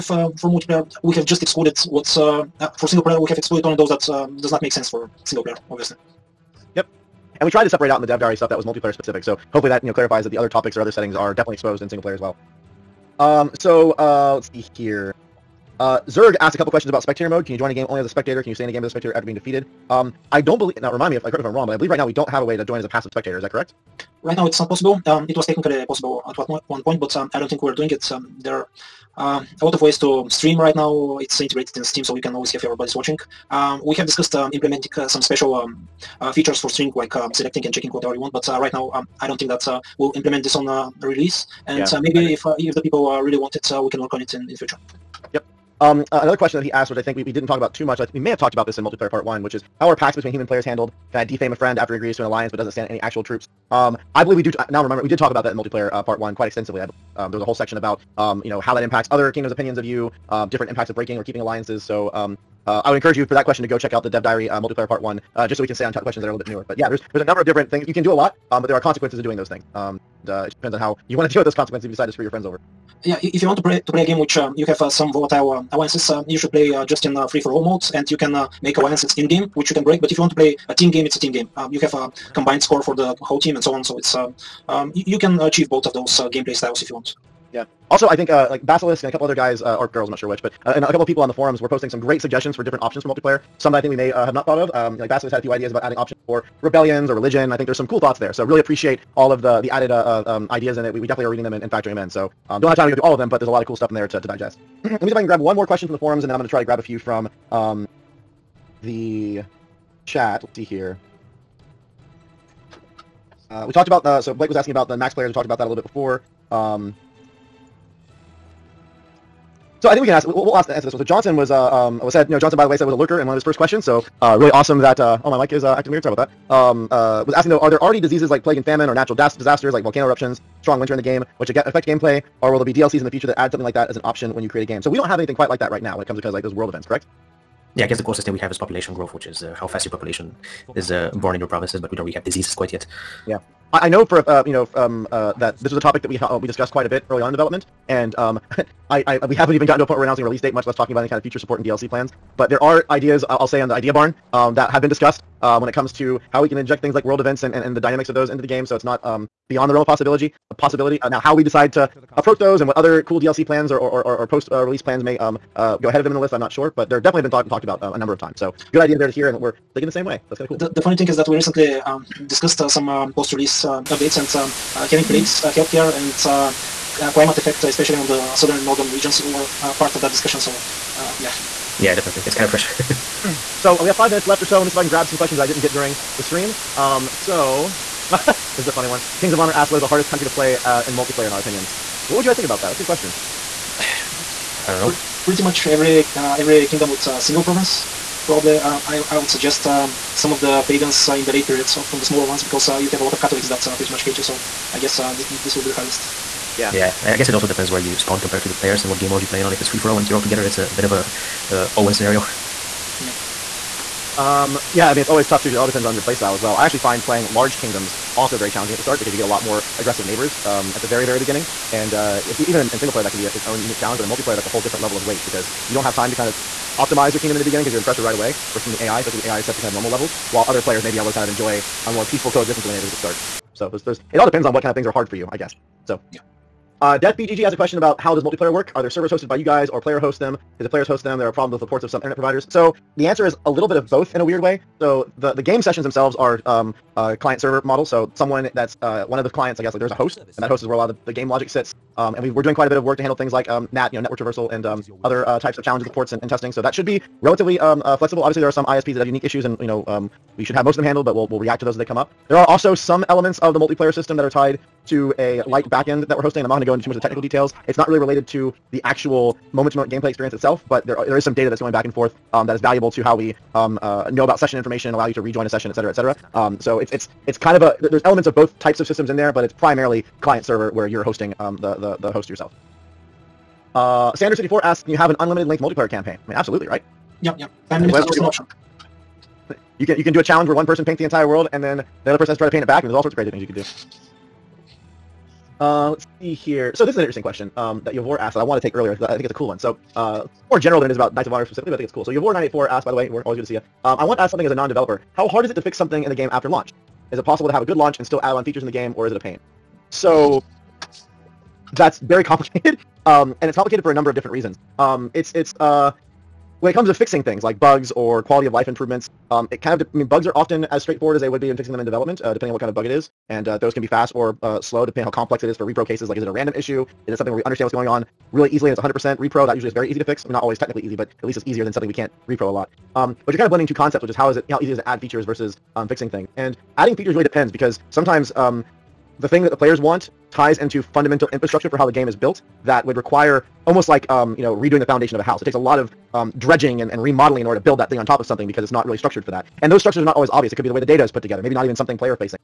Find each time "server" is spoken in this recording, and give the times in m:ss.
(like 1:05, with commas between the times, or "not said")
3:58, 4:07, 4:40.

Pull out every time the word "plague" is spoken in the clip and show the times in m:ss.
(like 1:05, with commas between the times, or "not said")
2:08, 2:55.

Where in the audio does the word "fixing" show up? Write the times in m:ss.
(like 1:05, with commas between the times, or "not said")
5:16, 5:21, 5:35.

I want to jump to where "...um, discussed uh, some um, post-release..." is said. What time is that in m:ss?
2:51.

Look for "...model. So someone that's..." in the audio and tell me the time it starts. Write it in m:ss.
4:07.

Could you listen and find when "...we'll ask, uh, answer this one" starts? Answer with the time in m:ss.
2:00.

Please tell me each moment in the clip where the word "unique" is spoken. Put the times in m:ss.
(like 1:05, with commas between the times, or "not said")
3:43, 4:19.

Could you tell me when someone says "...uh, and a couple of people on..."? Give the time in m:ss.
1:30.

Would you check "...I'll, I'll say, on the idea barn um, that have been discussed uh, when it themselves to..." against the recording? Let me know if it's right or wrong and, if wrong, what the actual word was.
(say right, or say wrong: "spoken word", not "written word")
wrong: "comes", not "themselves".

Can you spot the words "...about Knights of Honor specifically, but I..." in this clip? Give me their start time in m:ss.
5:00.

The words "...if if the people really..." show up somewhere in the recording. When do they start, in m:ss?
0:42.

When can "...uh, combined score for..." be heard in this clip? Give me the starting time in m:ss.
1:21.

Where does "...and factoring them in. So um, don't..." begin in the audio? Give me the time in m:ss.
1:41.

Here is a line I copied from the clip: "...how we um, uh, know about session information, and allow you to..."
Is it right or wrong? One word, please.
right.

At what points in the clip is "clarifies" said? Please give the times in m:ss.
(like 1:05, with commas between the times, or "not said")
0:09.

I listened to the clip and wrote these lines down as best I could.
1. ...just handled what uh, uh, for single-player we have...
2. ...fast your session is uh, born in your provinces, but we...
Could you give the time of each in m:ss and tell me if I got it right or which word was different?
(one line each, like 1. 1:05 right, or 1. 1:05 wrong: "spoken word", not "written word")
1. 0:01 wrong: "excluded", not "handled"
2. 2:19 wrong: "population", not "session".